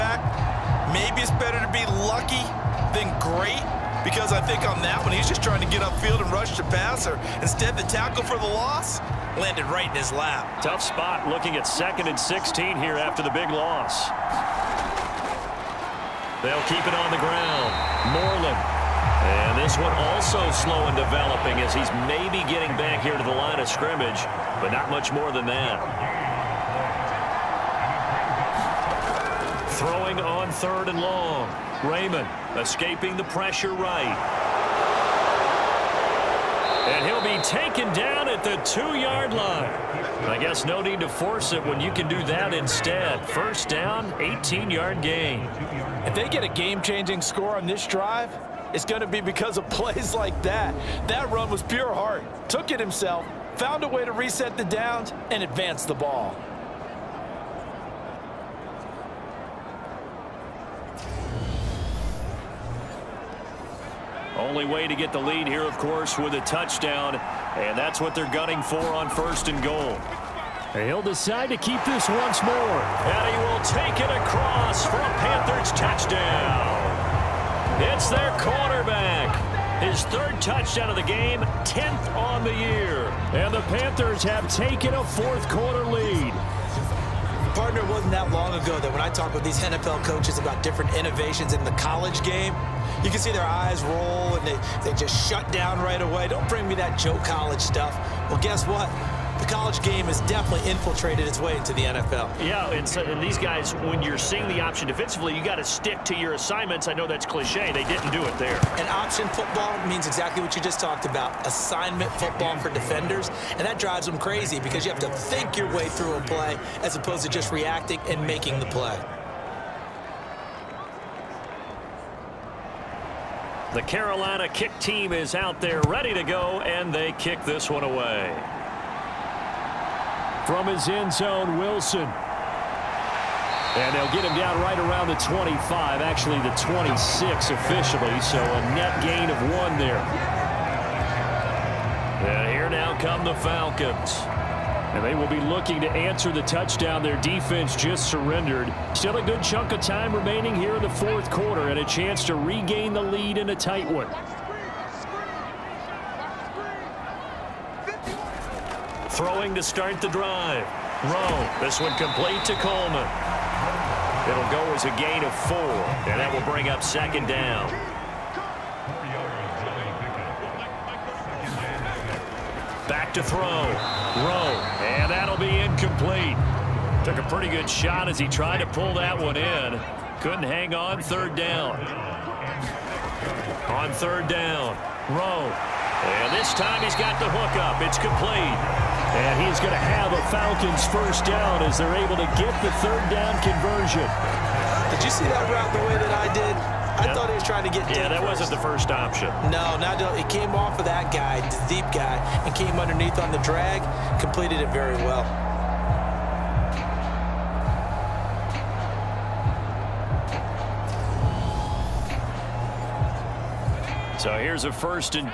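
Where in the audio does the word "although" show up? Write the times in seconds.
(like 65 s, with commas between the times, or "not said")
not said.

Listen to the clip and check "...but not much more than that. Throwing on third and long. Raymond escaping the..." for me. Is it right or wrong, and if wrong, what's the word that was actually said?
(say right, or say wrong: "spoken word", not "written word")
right.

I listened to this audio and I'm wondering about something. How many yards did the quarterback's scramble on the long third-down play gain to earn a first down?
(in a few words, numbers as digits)
18.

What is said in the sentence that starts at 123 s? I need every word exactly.
The Carolina kick team is out there ready to go, and they kick this one away.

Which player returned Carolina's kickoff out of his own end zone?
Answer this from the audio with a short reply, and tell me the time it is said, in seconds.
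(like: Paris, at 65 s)
Wilson, at 131 s.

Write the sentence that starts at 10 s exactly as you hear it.
Tough spot looking at second and 16 here after the big loss.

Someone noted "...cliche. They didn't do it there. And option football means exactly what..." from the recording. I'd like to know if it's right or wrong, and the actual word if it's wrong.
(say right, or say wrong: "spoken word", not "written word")
right.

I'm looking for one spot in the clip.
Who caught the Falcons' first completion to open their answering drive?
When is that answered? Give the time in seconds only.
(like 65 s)
162 s.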